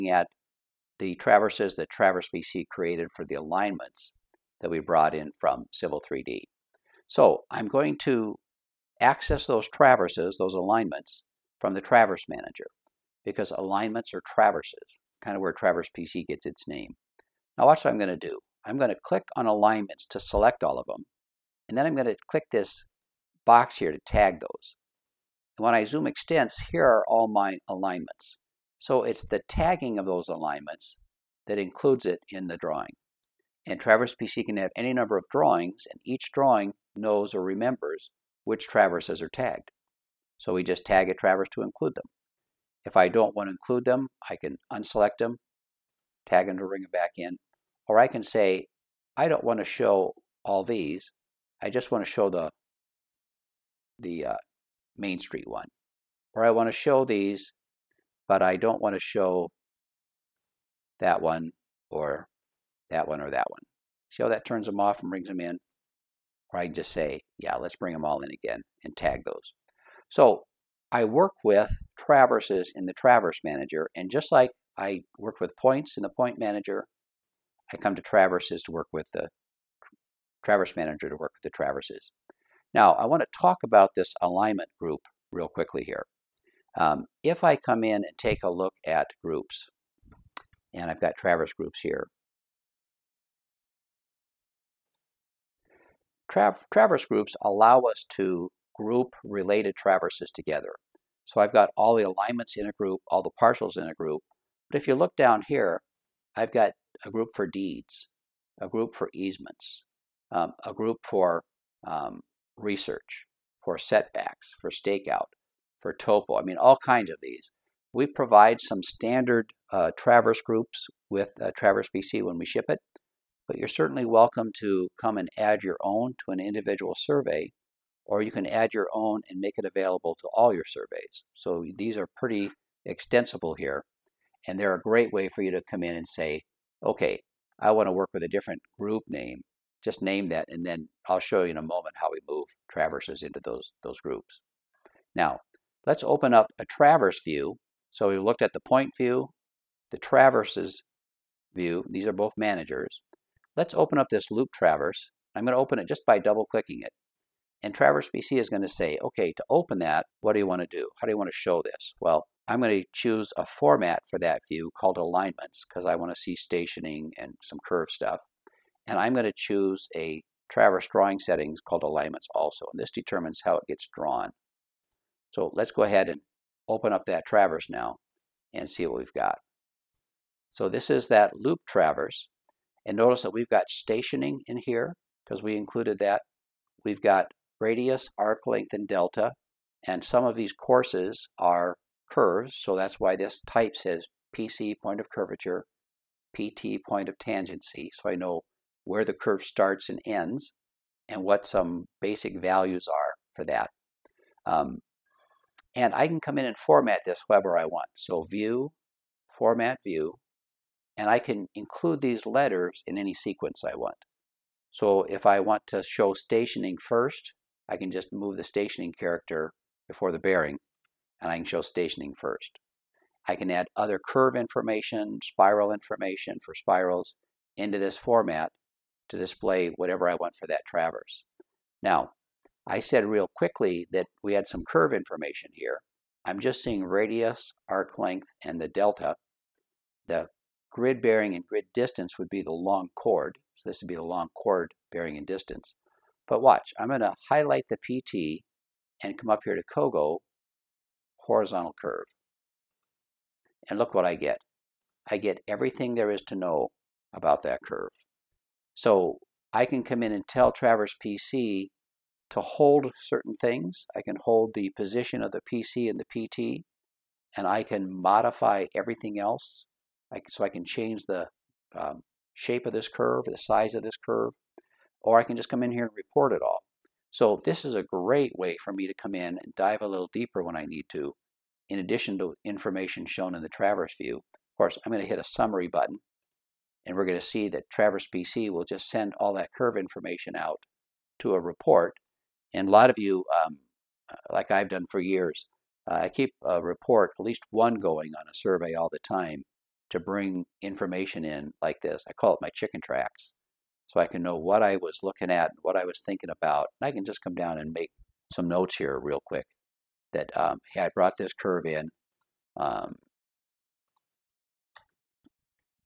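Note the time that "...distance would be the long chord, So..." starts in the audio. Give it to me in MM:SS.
04:01.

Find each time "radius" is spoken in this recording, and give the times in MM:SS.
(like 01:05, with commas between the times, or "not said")
03:07, 03:56.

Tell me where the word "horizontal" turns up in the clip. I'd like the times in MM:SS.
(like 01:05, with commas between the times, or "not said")
04:11.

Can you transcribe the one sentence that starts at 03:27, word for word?
So view, format view, and I can include these letters in any sequence I want.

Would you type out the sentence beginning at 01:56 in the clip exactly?
I mean, all kinds of these.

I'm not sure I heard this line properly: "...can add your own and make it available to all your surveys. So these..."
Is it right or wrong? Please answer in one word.
right.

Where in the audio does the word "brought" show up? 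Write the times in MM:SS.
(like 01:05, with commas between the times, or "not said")
00:04, 05:10.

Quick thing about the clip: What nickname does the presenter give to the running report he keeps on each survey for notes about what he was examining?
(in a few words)
chicken tracks.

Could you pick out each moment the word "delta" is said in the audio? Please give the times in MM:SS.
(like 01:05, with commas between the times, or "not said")
03:08, 03:58.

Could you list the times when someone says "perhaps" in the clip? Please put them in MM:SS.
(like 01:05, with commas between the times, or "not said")
not said.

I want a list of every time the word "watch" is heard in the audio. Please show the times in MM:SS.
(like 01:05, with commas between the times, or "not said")
00:17, 04:06.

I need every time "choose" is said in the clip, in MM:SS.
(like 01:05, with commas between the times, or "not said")
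02:42, 02:49.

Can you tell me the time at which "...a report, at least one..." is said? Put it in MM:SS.
04:56.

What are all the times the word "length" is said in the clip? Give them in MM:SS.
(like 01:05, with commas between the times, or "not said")
03:08, 03:57.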